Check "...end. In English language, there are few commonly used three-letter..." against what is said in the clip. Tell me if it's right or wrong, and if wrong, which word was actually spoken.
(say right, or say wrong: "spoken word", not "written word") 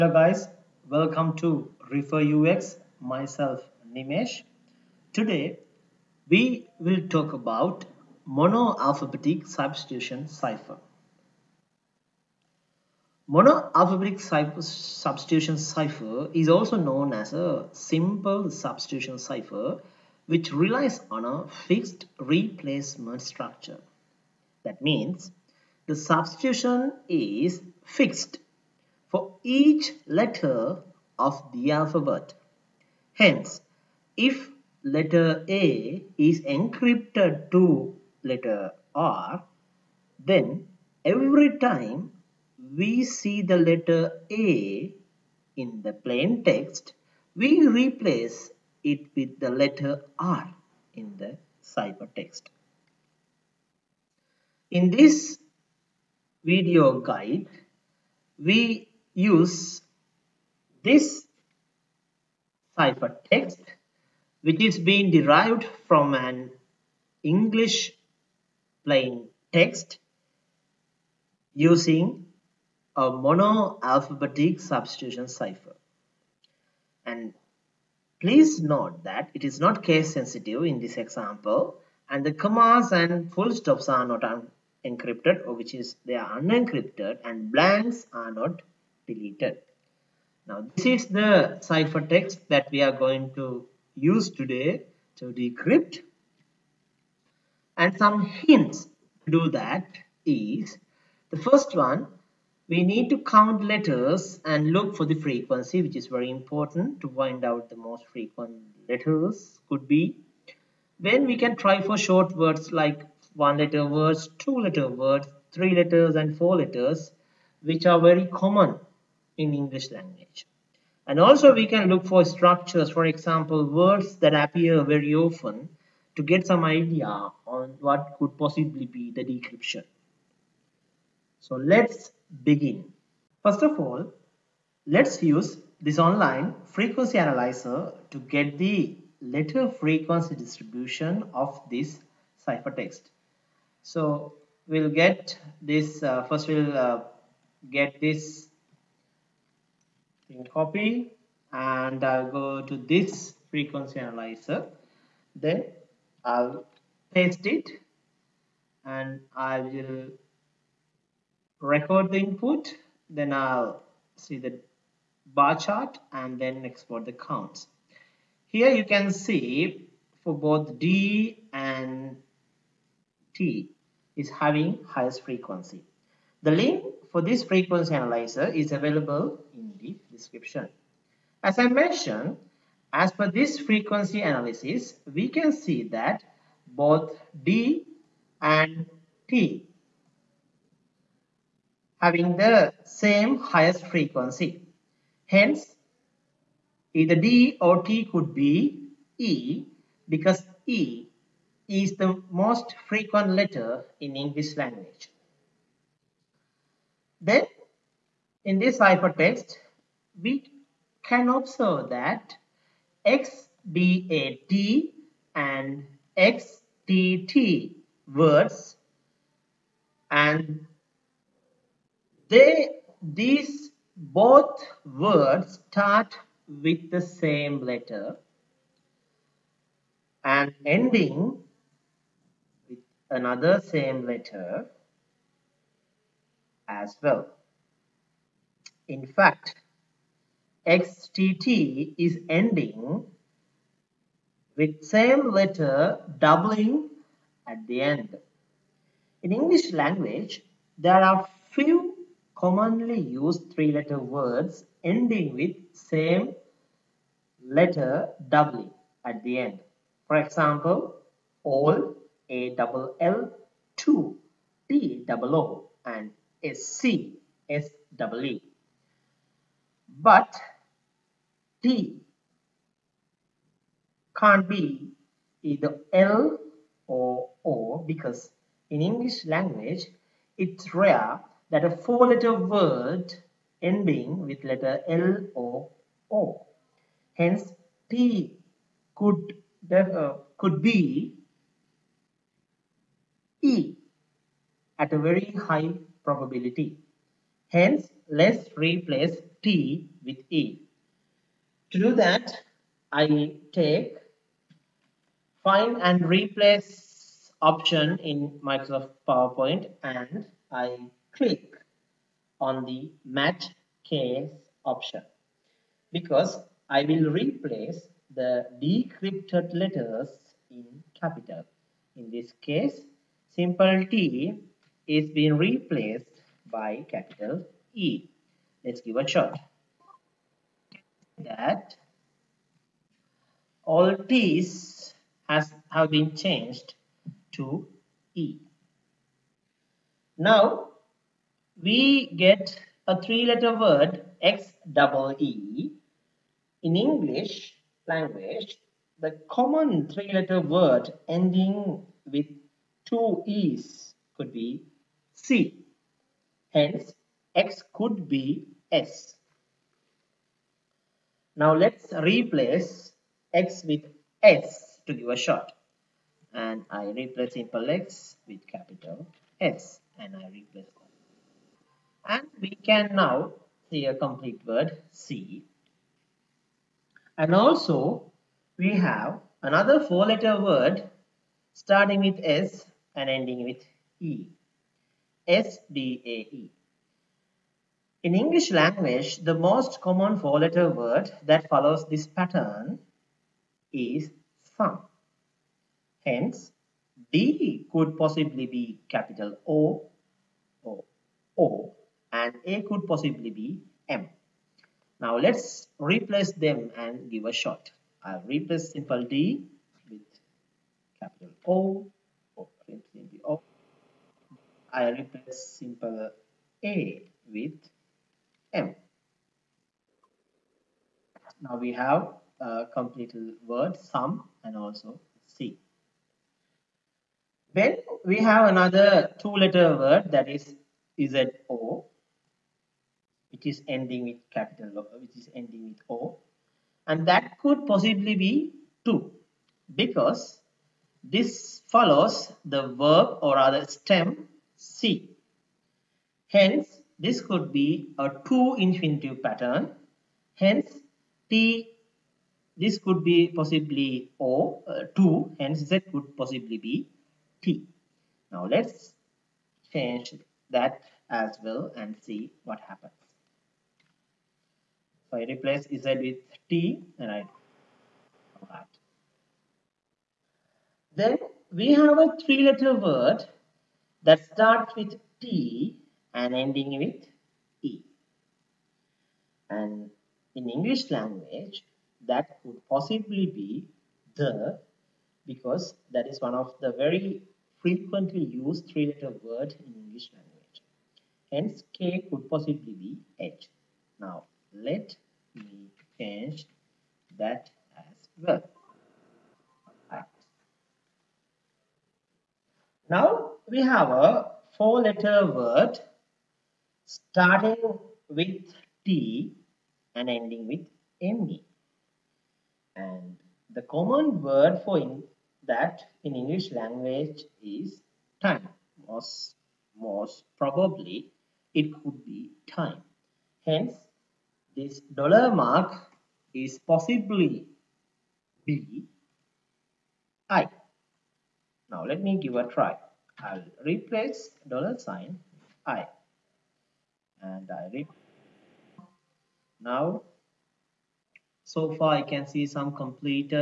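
right.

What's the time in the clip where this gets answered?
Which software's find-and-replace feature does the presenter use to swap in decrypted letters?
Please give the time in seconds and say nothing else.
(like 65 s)
308 s.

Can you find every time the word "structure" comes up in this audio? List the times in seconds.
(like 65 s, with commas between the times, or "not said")
23 s, 122 s.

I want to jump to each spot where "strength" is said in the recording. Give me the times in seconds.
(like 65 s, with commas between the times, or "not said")
not said.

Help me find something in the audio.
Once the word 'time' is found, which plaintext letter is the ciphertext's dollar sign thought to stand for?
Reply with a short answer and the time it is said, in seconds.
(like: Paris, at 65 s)
B, at 528 s.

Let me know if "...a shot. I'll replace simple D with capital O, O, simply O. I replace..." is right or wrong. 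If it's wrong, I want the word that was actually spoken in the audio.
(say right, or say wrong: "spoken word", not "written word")
right.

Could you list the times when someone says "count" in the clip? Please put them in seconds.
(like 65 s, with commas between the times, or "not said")
103 s, 167 s.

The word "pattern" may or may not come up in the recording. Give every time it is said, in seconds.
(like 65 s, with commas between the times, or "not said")
392 s, 449 s.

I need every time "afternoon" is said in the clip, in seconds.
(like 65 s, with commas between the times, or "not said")
not said.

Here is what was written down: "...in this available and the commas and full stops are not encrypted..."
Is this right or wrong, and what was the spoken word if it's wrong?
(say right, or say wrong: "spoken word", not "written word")
wrong: "example", not "available".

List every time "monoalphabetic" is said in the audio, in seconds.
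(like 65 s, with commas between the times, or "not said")
8 s, 13 s, 73 s.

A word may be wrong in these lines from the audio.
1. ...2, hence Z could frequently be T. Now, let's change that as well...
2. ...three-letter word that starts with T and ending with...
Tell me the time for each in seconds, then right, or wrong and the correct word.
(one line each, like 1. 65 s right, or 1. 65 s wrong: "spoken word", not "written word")
1. 454 s wrong: "possibly", not "frequently"
2. 472 s right.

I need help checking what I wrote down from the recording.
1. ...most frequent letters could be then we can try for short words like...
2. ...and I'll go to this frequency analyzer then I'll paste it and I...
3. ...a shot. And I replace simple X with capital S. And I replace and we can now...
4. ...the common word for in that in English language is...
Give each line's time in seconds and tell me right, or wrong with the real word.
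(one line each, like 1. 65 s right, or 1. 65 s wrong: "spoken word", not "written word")
1. 107 s right
2. 151 s right
3. 365 s right
4. 513 s right.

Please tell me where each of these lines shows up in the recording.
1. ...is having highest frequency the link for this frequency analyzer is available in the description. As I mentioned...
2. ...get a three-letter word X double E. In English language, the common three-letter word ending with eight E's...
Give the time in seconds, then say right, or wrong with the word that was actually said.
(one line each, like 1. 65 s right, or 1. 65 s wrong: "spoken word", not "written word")
1. 174 s right
2. 342 s wrong: "two", not "eight".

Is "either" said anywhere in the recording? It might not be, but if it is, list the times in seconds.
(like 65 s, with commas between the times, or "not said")
196 s, 275 s.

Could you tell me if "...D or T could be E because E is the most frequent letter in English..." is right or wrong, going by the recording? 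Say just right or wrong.
right.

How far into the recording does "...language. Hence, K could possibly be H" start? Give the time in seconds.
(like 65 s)
490 s.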